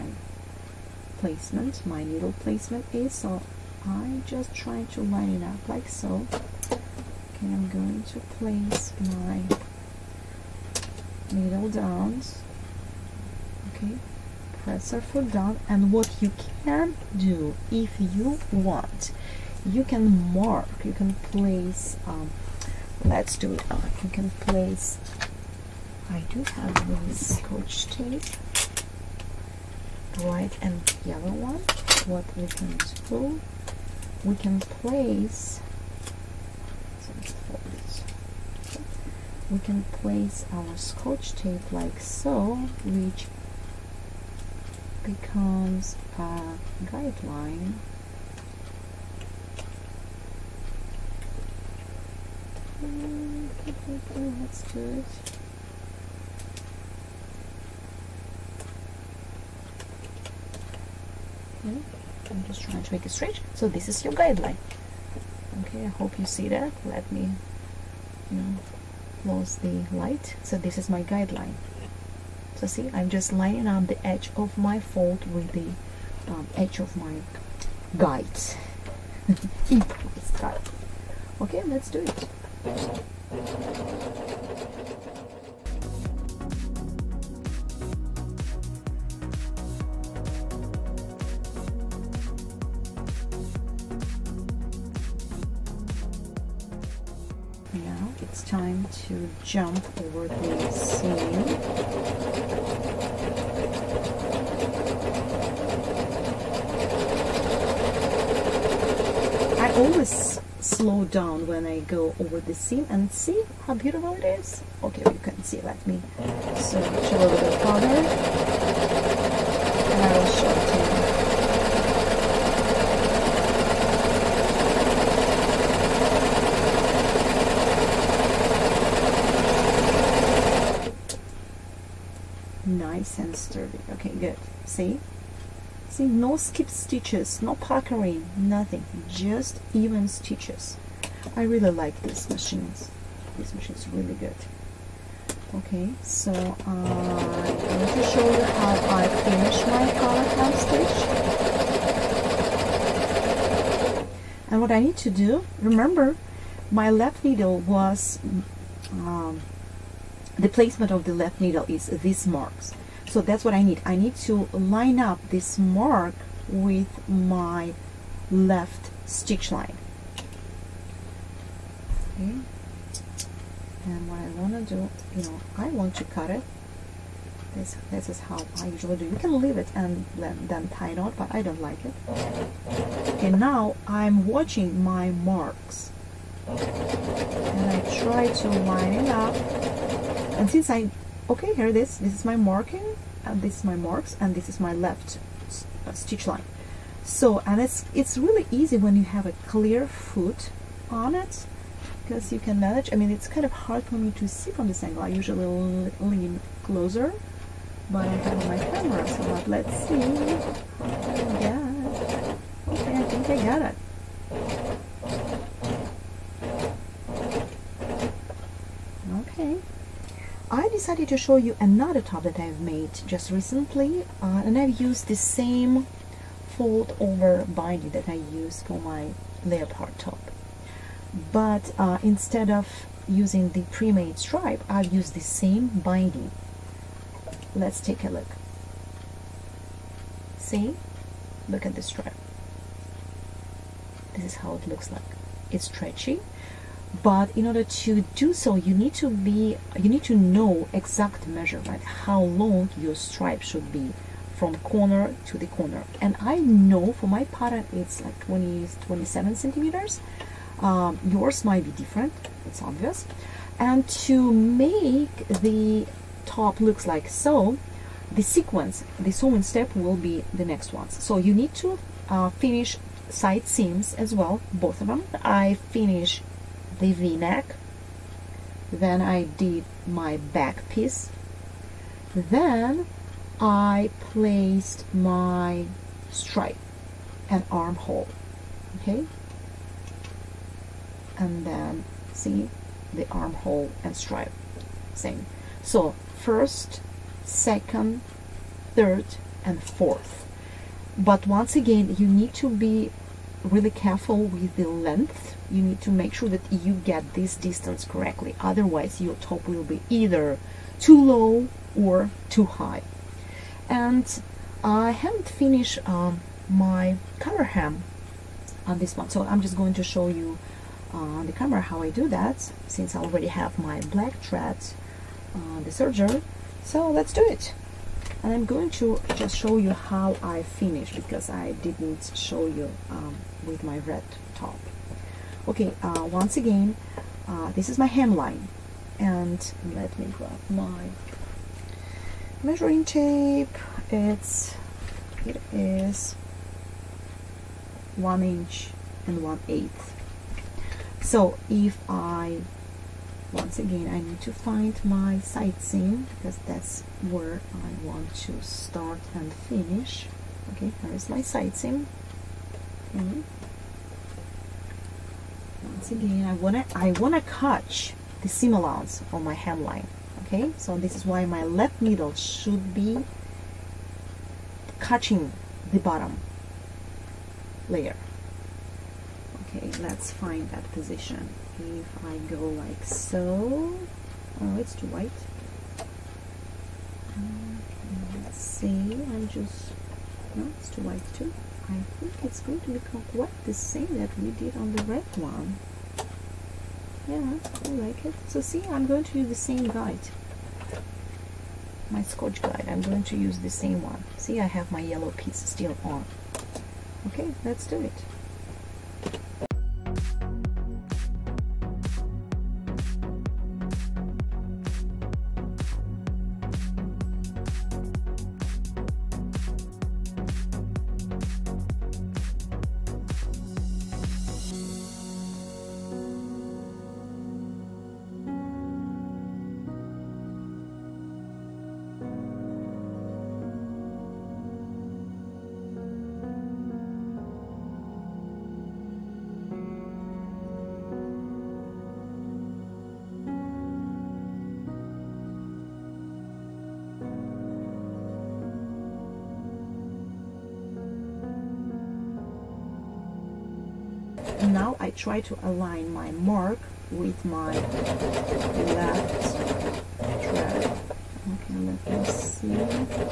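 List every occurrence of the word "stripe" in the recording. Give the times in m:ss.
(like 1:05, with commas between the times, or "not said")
3:54, 4:01, 4:12, 4:46, 4:53.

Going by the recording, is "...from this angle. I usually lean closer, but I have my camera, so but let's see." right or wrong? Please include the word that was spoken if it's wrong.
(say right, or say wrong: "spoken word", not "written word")
right.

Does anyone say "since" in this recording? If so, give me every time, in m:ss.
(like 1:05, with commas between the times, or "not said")
3:10, 5:22.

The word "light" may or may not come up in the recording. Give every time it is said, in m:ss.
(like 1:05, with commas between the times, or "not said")
1:09.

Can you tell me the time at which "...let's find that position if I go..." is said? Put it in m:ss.
6:19.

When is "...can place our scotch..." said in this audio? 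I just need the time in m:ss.
0:39.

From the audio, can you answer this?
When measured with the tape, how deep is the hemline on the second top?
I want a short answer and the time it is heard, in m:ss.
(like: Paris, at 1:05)
1 1/8 inches, at 5:47.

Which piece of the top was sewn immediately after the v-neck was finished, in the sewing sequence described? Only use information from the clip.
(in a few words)
Back piece.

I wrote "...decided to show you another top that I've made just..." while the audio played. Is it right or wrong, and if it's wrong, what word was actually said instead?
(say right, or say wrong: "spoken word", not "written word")
right.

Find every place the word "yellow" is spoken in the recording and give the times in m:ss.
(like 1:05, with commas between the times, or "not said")
0:31, 6:44.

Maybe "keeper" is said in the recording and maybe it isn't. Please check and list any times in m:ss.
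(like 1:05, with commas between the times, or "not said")
not said.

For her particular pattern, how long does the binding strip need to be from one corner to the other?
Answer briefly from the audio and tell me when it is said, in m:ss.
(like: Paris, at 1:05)
27 centimeters, at 4:18.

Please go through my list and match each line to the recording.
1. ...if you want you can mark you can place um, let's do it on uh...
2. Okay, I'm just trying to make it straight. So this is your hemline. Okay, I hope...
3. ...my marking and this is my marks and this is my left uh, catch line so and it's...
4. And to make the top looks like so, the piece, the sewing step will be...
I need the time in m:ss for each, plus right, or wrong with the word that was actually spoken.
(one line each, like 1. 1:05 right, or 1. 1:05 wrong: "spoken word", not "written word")
1. 0:17 right
2. 1:01 wrong: "guideline", not "hemline"
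3. 3:12 wrong: "stitch", not "catch"
4. 4:23 wrong: "sequence", not "piece".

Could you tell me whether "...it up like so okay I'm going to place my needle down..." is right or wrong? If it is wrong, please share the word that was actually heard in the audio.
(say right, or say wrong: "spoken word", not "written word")
right.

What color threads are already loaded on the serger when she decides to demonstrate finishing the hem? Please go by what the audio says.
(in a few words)
Black.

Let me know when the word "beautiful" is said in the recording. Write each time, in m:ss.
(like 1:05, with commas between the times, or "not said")
1:53.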